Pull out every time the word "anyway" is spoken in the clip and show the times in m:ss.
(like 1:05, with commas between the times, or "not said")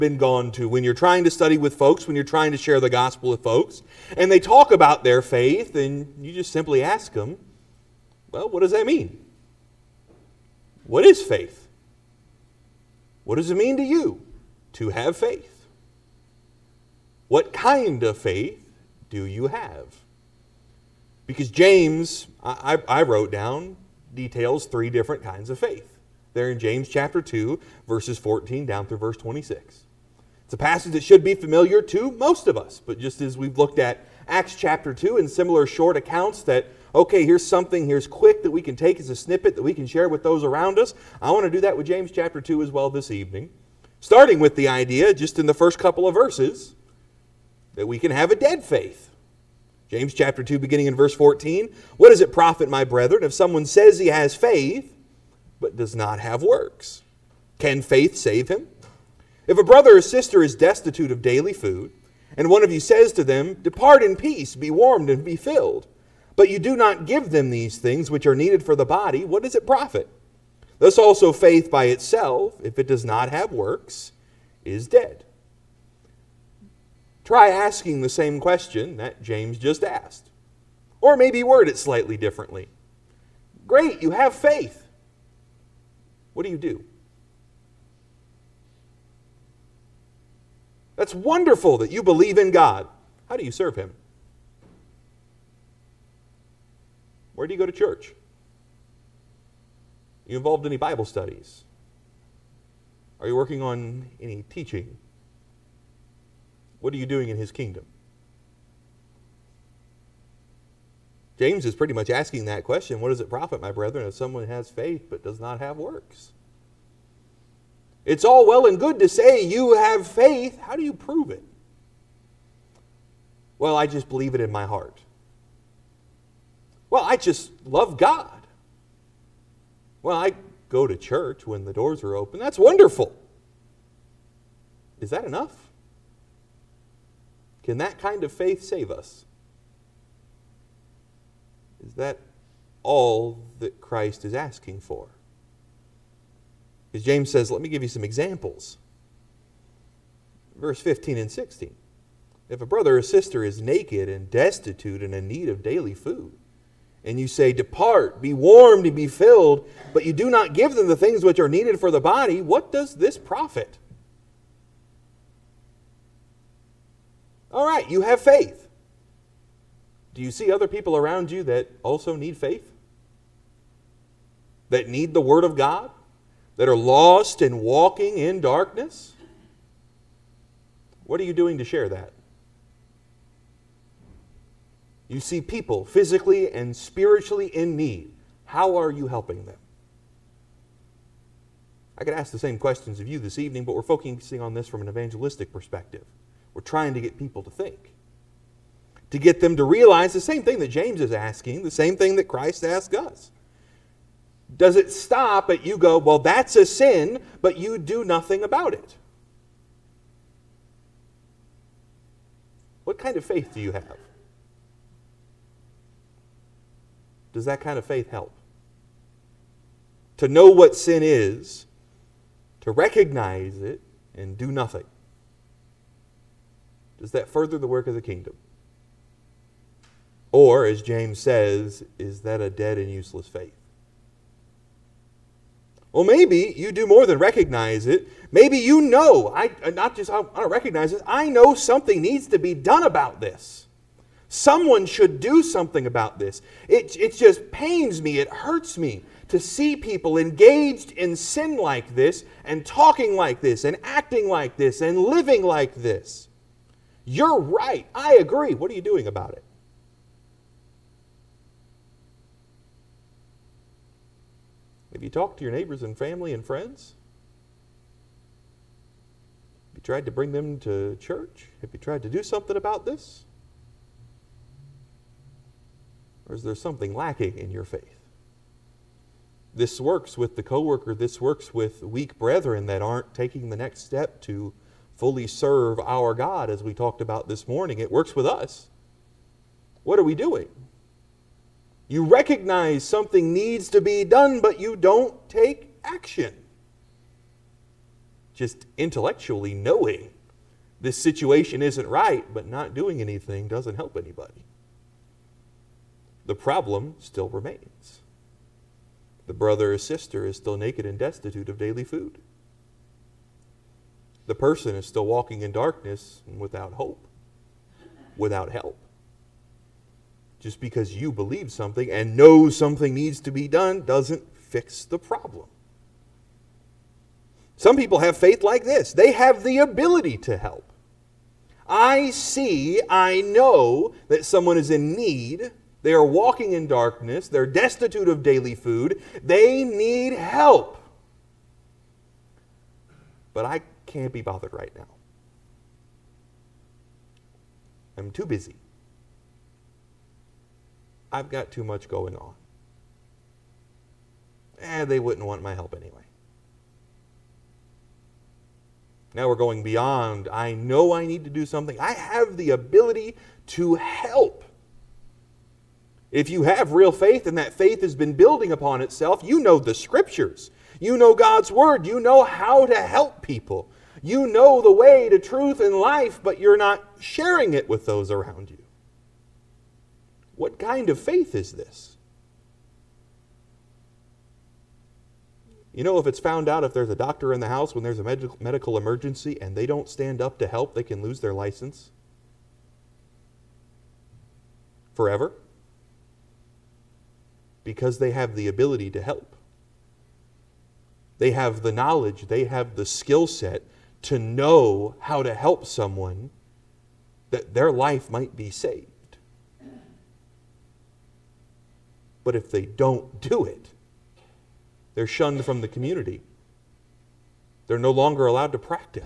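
5:55.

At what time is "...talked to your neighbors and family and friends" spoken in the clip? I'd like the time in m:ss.
4:25.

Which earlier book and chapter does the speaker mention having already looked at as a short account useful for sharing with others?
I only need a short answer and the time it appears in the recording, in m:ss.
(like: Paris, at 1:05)
Acts chapter 2, at 0:34.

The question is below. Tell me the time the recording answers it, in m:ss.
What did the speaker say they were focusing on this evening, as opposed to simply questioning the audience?
3:14.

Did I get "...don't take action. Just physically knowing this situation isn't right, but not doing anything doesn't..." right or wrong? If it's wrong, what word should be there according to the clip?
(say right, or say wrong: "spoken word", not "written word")
wrong: "intellectually", not "physically".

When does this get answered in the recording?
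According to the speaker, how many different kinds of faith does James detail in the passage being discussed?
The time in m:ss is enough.
0:24.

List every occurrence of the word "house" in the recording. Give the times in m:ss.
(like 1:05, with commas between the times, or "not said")
6:27.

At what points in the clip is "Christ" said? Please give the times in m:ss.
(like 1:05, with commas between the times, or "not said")
2:23, 3:22.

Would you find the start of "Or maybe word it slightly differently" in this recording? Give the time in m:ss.
1:21.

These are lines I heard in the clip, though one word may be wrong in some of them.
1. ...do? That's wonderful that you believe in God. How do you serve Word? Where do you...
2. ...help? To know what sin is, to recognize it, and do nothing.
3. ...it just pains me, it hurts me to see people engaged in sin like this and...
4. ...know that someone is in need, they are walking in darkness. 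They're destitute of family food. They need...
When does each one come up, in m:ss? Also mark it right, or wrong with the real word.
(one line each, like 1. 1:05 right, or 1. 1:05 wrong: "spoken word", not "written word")
1. 1:26 wrong: "Him", not "Word"
2. 3:38 right
3. 4:06 right
4. 5:33 wrong: "daily", not "family".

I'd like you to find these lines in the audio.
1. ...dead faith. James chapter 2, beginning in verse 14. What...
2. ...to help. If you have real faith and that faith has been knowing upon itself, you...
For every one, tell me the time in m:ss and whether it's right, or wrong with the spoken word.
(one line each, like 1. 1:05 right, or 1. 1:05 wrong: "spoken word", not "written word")
1. 0:48 right
2. 6:03 wrong: "building", not "knowing".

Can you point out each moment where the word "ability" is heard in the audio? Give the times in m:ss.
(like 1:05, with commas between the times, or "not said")
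5:29, 6:02, 6:38.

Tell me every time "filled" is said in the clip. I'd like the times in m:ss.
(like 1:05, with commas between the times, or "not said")
1:05, 2:39.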